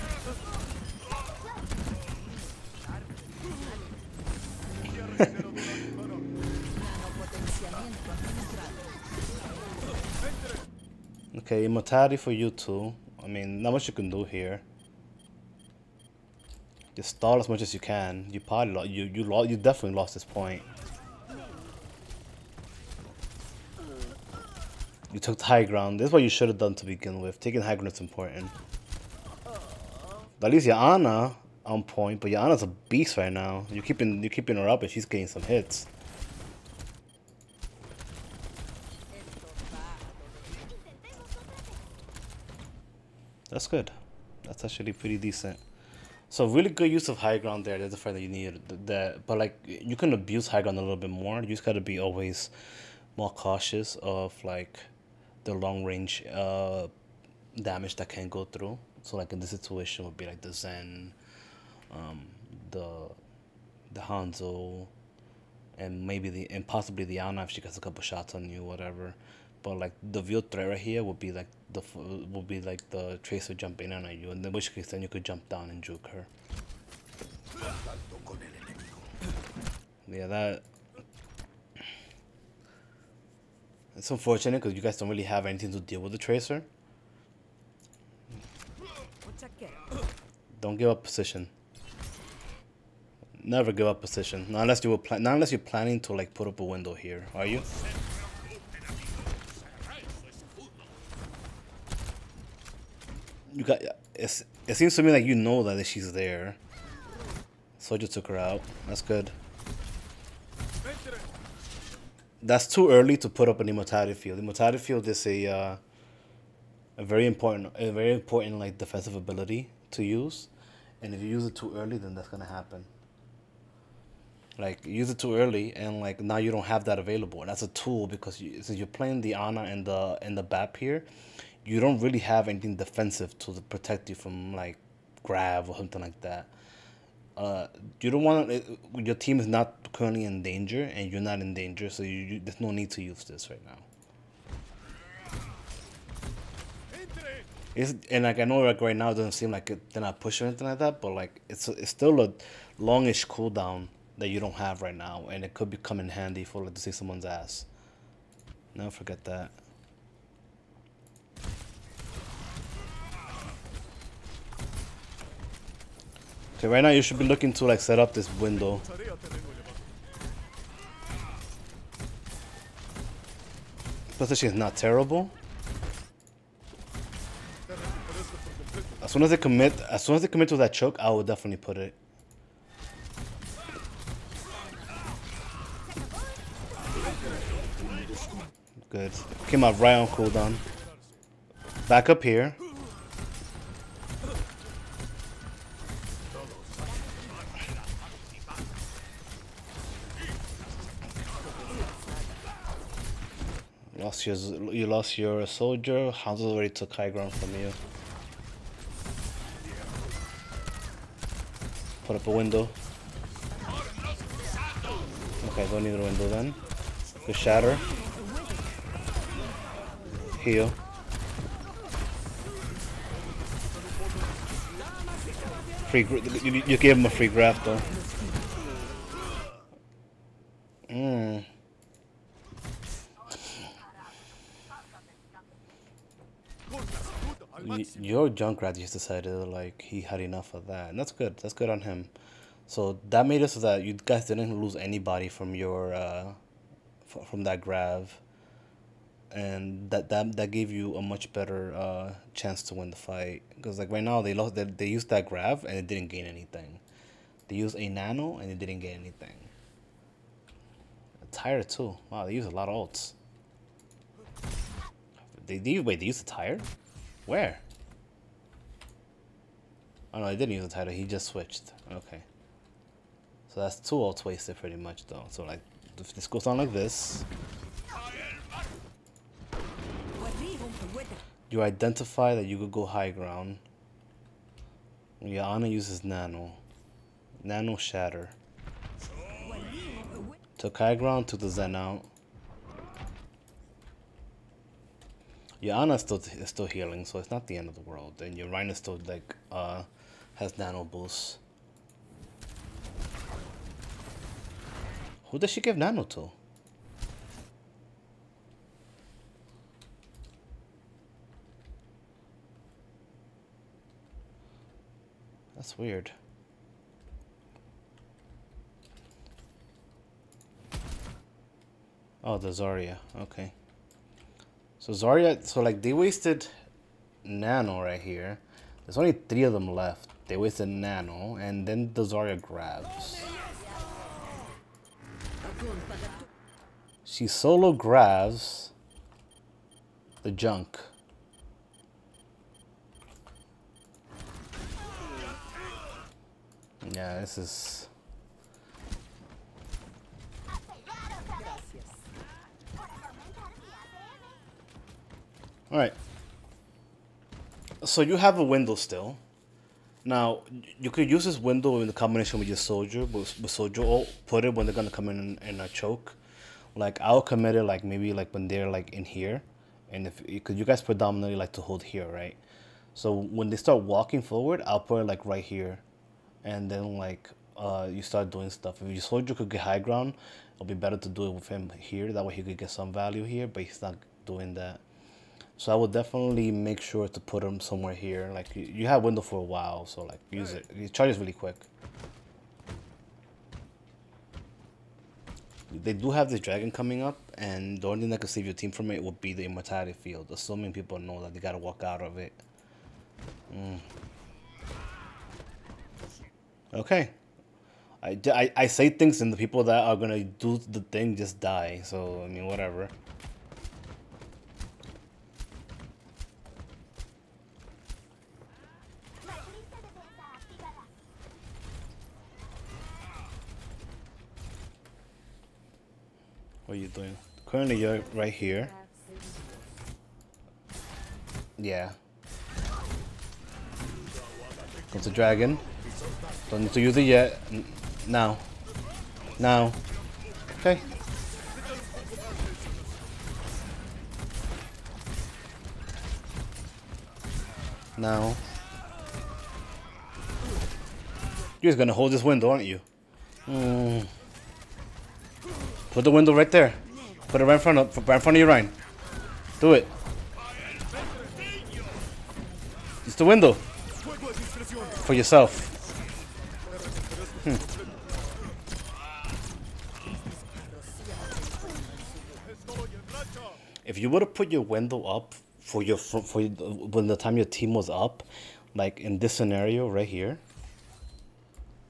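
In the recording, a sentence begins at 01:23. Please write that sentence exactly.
It's unfortunate because you guys don't really have anything to deal with the tracer.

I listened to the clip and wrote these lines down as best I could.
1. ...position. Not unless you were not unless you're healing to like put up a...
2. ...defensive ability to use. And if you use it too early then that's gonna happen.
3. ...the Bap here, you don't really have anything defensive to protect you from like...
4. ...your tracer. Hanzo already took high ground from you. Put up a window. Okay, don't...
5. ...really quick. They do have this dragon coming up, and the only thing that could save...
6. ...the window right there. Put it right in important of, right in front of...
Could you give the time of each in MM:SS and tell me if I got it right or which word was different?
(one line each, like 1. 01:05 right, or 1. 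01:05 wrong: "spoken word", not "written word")
1. 01:34 wrong: "planning", not "healing"
2. 01:58 right
3. 02:10 right
4. 03:25 wrong: "soldier", not "tracer"
5. 06:31 right
6. 07:36 wrong: "front", not "important".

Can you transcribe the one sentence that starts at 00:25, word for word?
This is what you should have done to begin with.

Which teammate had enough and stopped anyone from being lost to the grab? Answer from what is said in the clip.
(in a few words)
Junkrat.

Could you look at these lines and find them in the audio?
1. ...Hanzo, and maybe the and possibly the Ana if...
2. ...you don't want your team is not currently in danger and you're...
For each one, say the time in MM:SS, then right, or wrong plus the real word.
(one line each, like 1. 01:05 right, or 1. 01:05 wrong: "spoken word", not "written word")
1. 01:04 right
2. 02:18 right.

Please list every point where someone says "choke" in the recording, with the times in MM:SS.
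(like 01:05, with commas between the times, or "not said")
03:00, 06:05.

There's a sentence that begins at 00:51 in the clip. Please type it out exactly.
You just gotta be always more cautious of like the long range uh damage that can go through.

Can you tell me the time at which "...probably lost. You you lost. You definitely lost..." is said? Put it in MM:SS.
00:18.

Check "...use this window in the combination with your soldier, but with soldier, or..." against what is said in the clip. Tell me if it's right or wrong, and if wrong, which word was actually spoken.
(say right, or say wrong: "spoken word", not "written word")
right.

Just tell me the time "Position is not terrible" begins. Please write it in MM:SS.
02:54.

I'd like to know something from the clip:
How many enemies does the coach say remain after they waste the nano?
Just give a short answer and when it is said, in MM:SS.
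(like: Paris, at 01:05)
3, at 05:29.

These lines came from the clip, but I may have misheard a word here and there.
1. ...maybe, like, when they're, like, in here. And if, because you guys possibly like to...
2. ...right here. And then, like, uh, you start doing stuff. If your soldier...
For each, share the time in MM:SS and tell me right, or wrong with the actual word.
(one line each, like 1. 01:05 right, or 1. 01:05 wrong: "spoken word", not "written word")
1. 06:07 wrong: "predominantly", not "possibly"
2. 06:15 right.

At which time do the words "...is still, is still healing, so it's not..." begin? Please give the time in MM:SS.
04:55.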